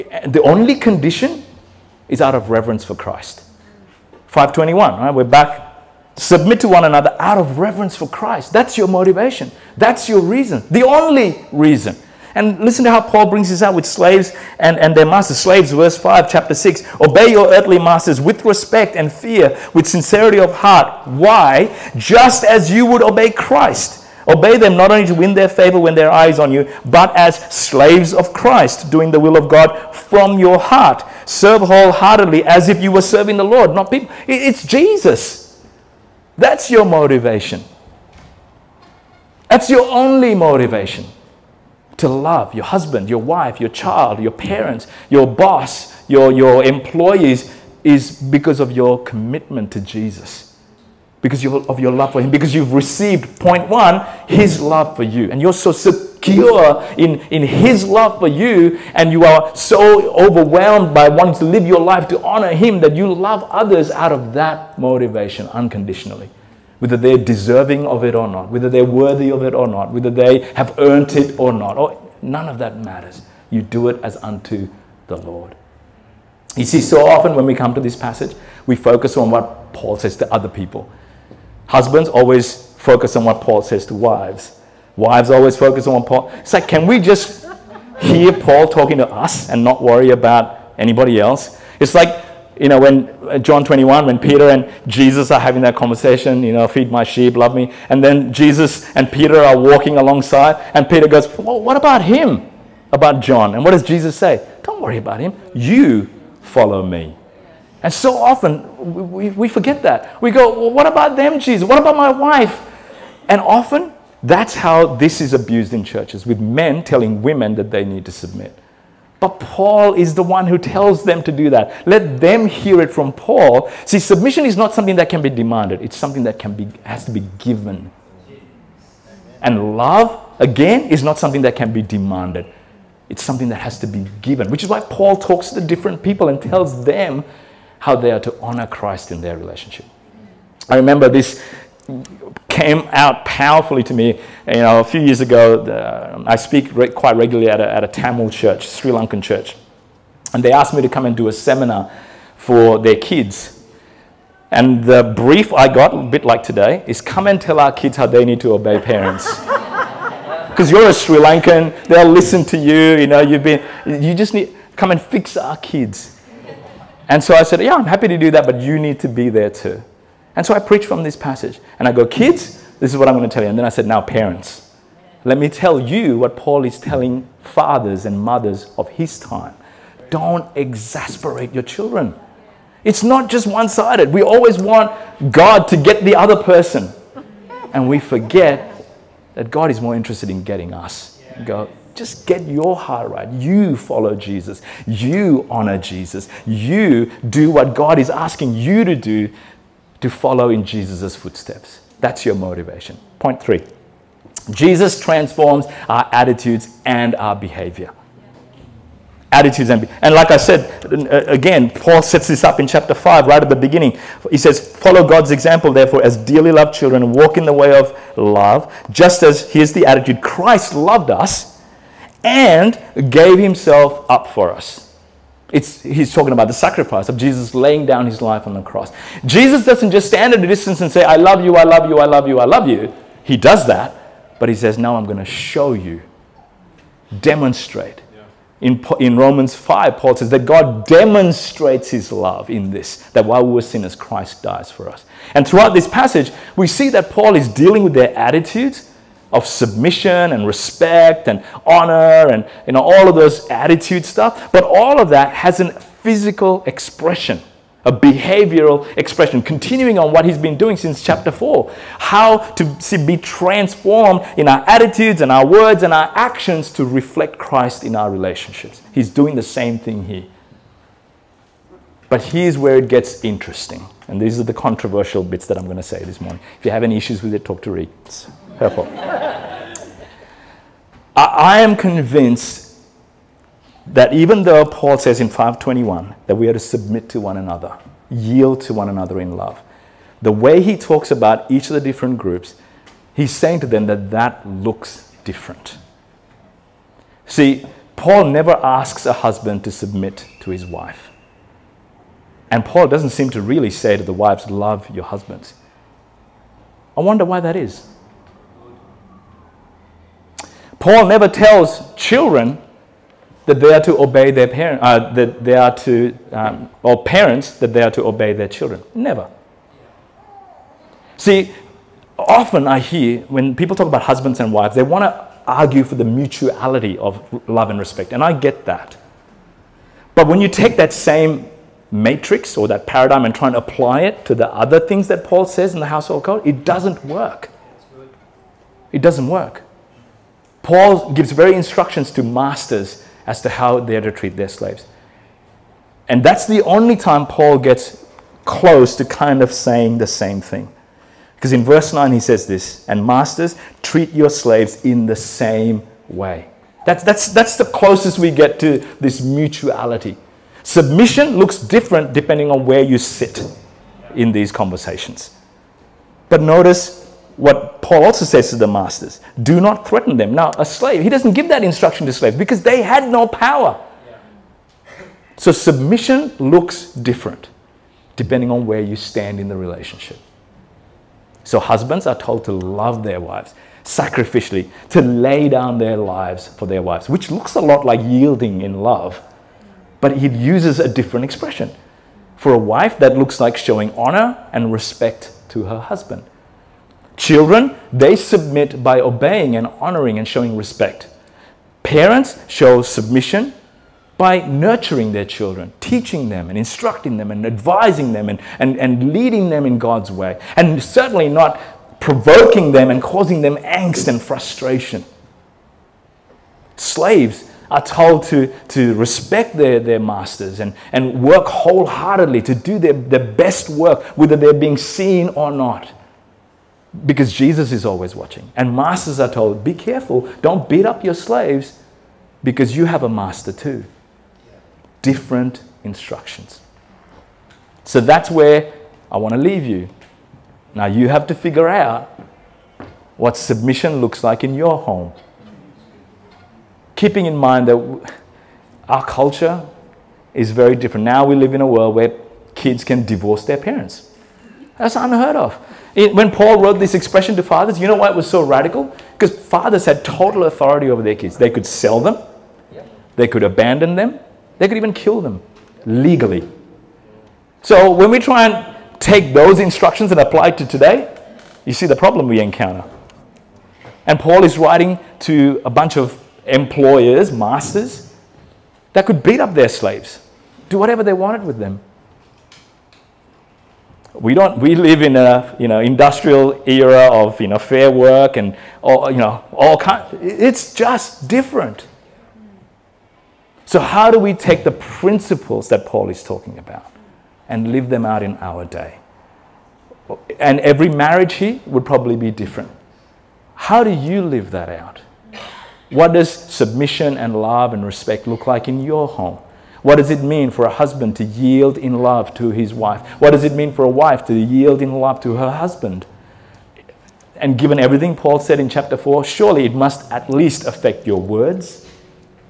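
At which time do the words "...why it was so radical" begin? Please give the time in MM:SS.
07:37.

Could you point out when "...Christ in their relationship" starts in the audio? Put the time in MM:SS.
02:18.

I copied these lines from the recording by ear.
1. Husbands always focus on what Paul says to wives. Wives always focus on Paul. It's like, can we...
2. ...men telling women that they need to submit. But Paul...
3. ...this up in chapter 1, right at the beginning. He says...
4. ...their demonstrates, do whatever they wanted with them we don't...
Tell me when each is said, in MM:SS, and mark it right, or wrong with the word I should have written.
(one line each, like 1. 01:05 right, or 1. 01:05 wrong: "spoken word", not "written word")
1. 01:21 right
2. 01:56 right
3. 03:32 wrong: "5", not "1"
4. 07:59 wrong: "slaves", not "demonstrates".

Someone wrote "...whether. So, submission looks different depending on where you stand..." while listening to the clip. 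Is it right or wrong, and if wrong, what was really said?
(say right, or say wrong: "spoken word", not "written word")
wrong: "power", not "whether".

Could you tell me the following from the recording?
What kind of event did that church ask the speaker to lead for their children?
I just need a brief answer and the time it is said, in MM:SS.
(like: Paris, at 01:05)
A seminar, at 02:31.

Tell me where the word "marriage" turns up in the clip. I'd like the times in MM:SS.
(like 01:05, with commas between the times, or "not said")
08:20.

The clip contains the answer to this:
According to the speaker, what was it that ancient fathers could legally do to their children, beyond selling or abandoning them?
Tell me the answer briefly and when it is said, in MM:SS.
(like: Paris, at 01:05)
Kill them, at 07:44.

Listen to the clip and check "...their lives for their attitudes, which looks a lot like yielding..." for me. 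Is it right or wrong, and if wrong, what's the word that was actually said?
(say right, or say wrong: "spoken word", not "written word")
wrong: "wives", not "attitudes".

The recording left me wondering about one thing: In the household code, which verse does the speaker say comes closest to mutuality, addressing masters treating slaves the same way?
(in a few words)
Verse 9.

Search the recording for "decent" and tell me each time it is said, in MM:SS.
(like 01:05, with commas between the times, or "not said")
not said.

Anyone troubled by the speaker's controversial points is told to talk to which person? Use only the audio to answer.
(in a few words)
Reed.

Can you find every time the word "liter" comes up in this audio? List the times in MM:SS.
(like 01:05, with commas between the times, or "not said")
not said.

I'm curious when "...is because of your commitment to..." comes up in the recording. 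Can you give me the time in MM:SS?
00:47.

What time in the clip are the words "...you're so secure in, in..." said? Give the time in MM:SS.
00:55.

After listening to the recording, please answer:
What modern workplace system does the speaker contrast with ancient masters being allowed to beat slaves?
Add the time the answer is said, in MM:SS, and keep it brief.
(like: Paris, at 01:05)
Fair work, at 08:07.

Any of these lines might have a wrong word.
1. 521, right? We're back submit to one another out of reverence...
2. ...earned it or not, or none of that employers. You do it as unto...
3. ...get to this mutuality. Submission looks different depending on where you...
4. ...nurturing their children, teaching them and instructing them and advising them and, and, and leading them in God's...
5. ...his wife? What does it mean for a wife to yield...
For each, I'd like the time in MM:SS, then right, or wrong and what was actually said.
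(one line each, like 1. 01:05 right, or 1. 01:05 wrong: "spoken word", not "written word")
1. 00:04 right
2. 01:10 wrong: "matters", not "employers"
3. 05:58 right
4. 06:44 right
5. 08:32 right.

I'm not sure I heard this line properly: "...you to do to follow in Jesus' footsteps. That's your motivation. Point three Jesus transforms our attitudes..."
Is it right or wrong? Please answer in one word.
right.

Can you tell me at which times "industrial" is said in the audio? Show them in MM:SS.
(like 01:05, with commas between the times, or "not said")
08:05.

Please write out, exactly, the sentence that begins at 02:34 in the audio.
And the brief I got, a bit like today, is come and tell our kids how they need to obey parents.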